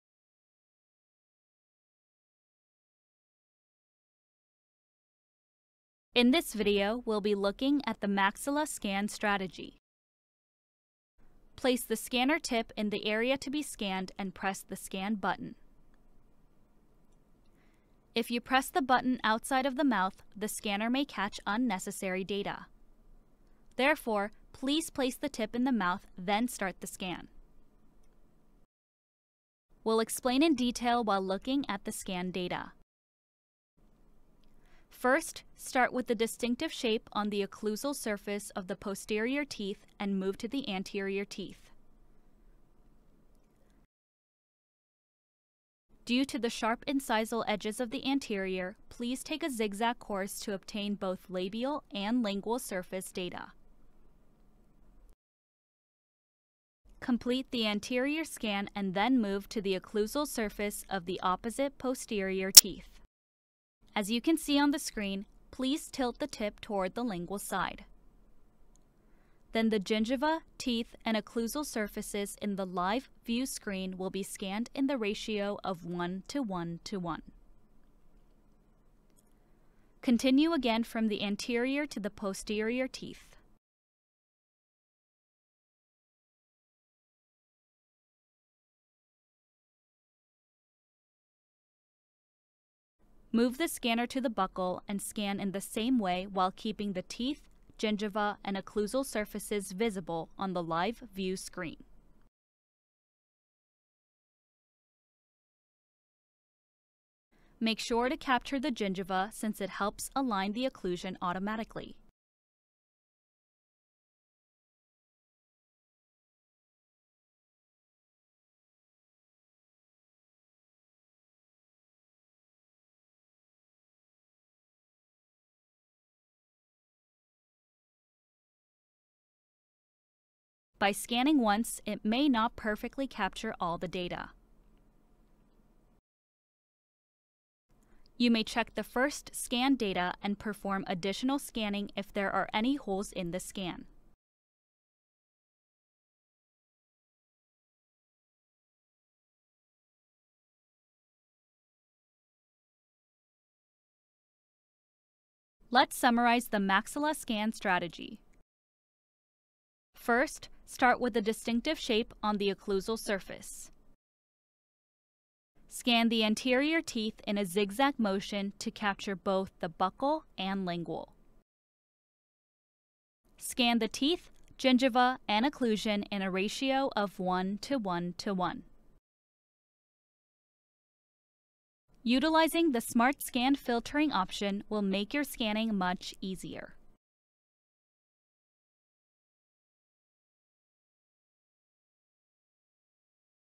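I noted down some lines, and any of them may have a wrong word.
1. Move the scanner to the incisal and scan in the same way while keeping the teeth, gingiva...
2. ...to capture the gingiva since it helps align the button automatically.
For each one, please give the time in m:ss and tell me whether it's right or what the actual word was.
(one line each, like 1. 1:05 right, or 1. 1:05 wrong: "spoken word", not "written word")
1. 1:33 wrong: "buccal", not "incisal"
2. 1:48 wrong: "occlusion", not "button".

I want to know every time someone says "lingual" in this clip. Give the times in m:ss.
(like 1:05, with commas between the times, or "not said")
0:52, 1:07, 2:50.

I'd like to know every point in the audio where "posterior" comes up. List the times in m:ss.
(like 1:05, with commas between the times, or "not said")
0:38, 1:01, 1:22.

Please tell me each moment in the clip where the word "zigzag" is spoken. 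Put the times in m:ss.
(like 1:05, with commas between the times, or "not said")
0:49, 2:47.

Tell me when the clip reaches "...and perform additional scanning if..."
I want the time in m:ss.
2:20.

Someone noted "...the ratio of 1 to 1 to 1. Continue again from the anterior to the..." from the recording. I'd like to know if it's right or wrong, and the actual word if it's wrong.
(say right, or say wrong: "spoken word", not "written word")
right.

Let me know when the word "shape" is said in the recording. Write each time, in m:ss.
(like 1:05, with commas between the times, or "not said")
0:36, 2:41.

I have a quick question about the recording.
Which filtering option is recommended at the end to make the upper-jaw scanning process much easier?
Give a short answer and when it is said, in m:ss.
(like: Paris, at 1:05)
Smart Scan, at 3:02.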